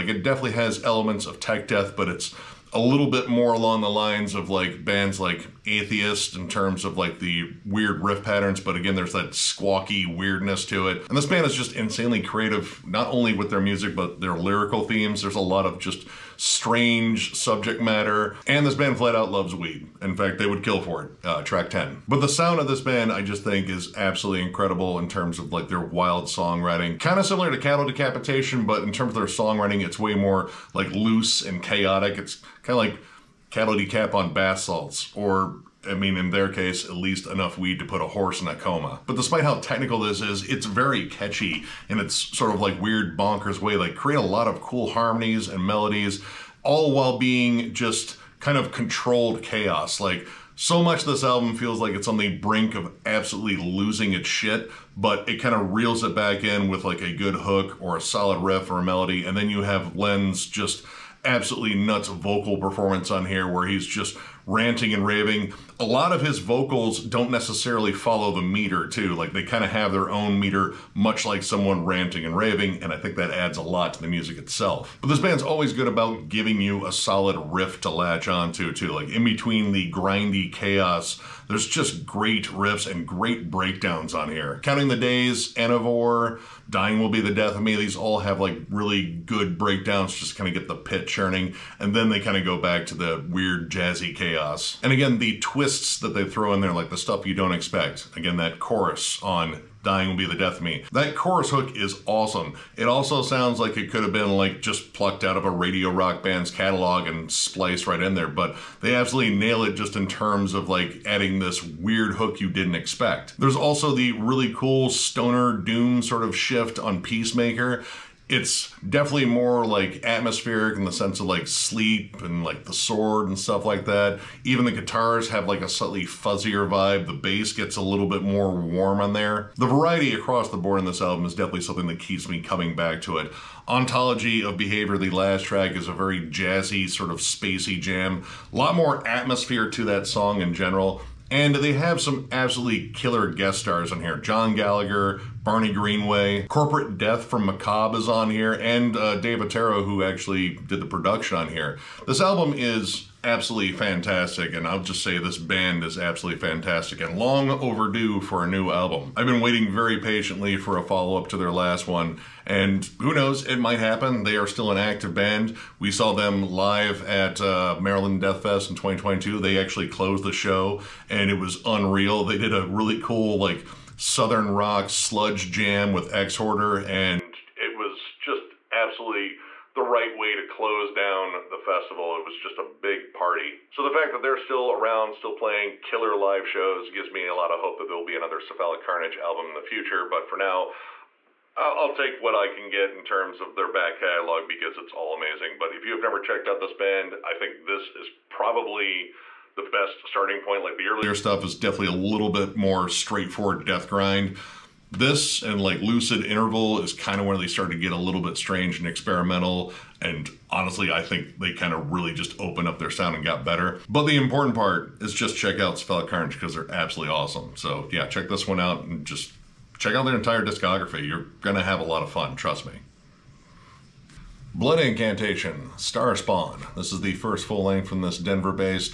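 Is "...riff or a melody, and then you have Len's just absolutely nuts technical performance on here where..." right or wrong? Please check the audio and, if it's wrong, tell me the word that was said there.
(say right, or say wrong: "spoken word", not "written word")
wrong: "vocal", not "technical".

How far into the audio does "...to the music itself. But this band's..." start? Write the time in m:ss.
1:13.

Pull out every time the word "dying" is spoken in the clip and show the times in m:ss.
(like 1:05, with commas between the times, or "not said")
1:26, 1:39.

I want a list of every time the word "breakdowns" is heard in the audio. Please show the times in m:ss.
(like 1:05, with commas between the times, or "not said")
1:23, 1:29.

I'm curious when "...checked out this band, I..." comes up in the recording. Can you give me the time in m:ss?
3:16.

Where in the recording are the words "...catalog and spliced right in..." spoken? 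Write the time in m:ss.
1:46.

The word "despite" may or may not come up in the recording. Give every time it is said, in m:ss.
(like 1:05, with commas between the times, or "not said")
0:39.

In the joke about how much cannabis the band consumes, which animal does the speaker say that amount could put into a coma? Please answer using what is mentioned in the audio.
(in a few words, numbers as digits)
horse.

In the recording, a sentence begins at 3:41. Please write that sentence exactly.
You're going to have a lot of fun, trust me.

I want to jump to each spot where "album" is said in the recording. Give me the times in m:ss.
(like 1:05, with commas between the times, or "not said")
0:51, 2:11, 2:32, 2:38, 3:09.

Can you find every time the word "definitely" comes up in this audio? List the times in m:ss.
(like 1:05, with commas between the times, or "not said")
0:00, 1:58, 2:11, 3:21.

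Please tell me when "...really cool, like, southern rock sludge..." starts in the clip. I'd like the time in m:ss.
2:52.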